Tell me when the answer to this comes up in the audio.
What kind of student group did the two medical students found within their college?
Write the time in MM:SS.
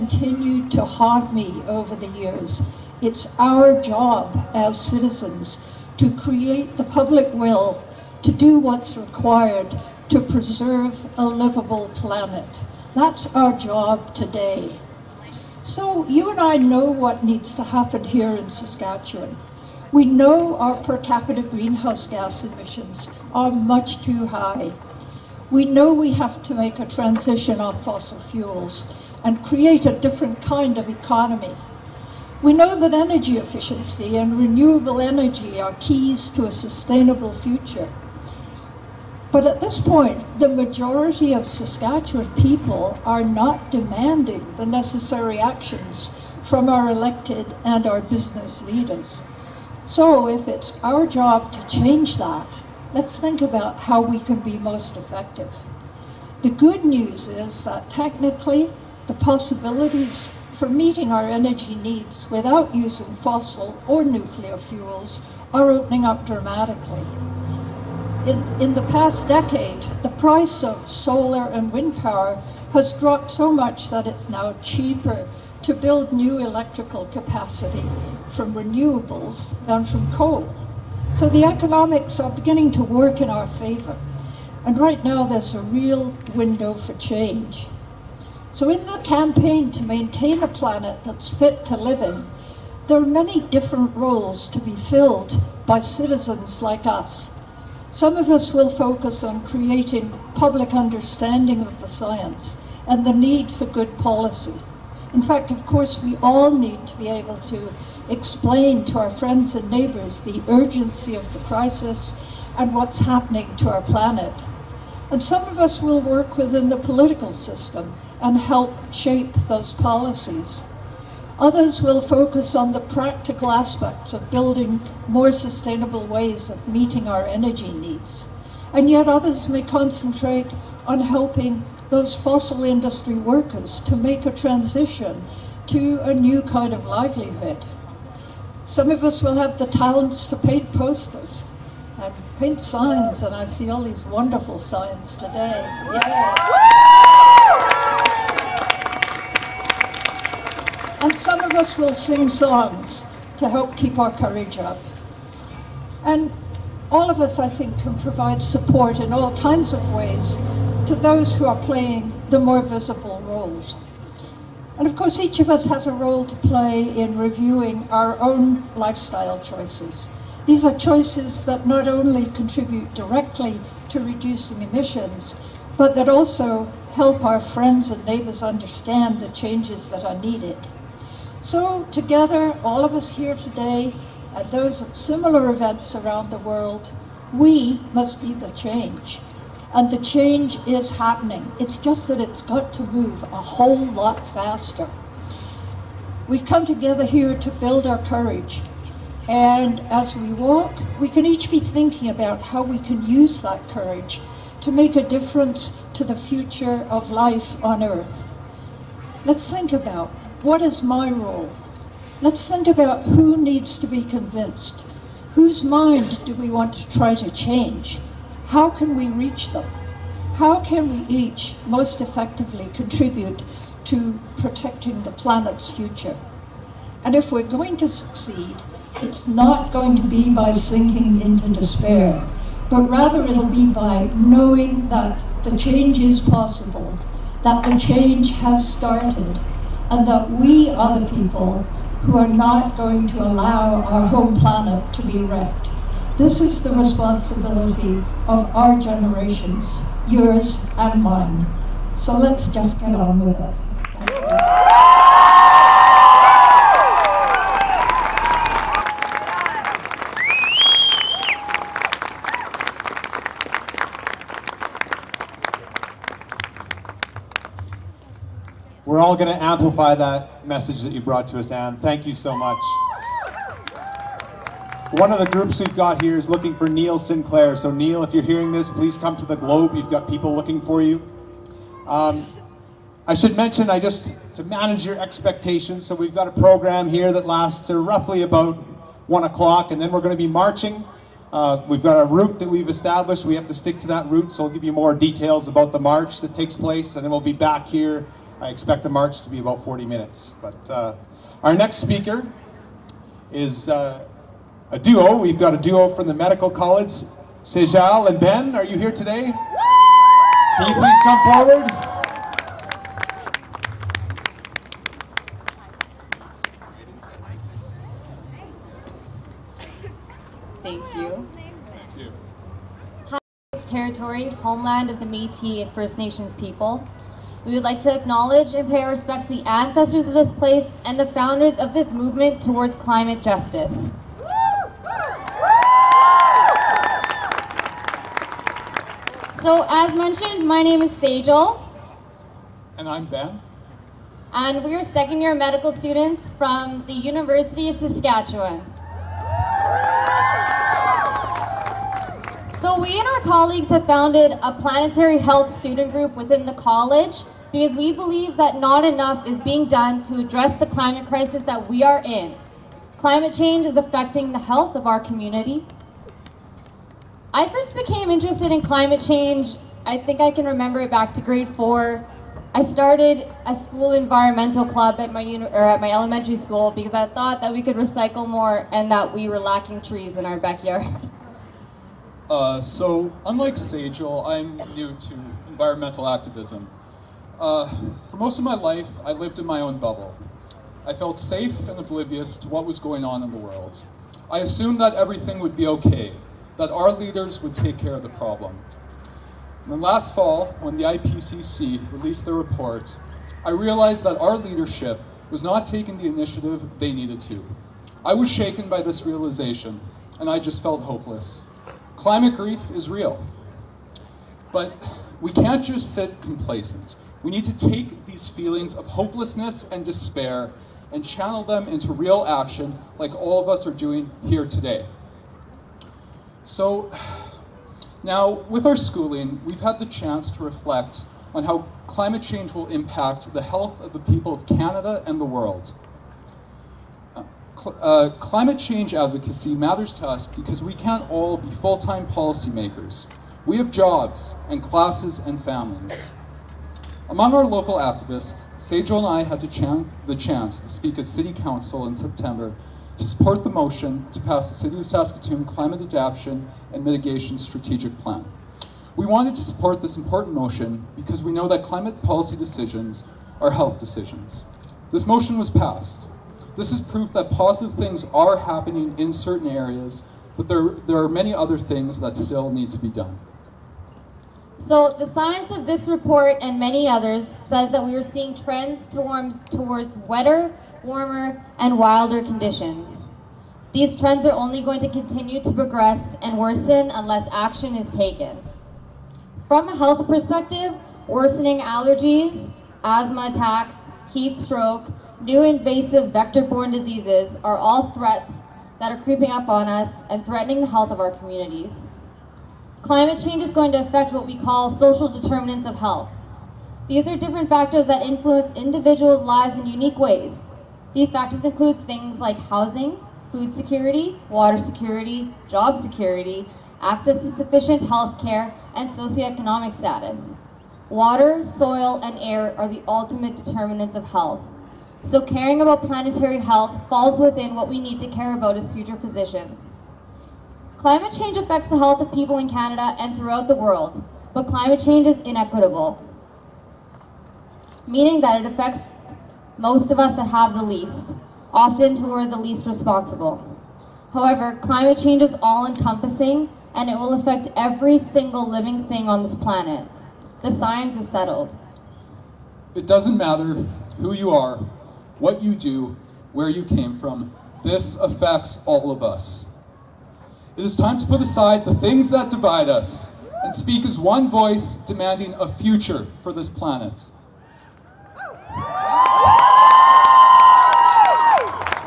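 05:54.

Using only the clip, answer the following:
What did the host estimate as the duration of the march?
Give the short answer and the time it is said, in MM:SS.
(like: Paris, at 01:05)
40 minutes, at 04:59.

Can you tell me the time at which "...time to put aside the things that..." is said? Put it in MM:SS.
09:20.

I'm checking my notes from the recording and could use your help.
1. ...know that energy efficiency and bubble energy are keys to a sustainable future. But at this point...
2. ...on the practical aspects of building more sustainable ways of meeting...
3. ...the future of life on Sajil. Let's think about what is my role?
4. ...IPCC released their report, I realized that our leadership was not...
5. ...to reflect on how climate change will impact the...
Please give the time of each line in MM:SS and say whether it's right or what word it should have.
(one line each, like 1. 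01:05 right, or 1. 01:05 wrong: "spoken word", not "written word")
1. 00:32 wrong: "renewable", not "bubble"
2. 02:02 right
3. 03:26 wrong: "Earth", not "Sajil"
4. 06:40 right
5. 07:10 right.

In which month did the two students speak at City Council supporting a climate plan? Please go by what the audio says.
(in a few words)
September.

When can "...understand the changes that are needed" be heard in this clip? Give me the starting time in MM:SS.
02:58.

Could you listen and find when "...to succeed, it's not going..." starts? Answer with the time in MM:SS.
03:47.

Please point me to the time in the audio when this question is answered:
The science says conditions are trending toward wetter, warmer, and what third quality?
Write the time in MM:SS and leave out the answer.
08:01.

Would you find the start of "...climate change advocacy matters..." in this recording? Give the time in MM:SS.
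07:18.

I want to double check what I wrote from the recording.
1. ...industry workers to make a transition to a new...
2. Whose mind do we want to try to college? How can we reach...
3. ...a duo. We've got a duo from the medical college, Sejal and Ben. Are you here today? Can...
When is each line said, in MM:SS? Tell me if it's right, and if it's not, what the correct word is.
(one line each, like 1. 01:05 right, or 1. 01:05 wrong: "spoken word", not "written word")
1. 02:12 right
2. 03:35 wrong: "change", not "college"
3. 05:04 right.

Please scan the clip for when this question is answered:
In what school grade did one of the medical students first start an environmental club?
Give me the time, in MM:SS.
06:11.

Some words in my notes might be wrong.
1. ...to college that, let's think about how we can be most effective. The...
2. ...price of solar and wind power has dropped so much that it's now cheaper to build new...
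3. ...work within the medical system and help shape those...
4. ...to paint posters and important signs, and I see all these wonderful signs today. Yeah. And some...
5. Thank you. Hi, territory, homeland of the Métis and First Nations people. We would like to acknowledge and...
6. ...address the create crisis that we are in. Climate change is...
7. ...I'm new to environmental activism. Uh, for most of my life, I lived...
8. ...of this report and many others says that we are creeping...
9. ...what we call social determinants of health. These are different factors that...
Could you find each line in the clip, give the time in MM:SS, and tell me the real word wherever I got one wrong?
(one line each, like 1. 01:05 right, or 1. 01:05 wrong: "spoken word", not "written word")
1. 00:51 wrong: "change", not "college"
2. 01:10 right
3. 01:56 wrong: "political", not "medical"
4. 02:20 wrong: "paint", not "important"
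5. 05:21 right
6. 06:00 wrong: "climate", not "create"
7. 06:24 right
8. 07:55 wrong: "seeing", not "creeping"
9. 08:24 right.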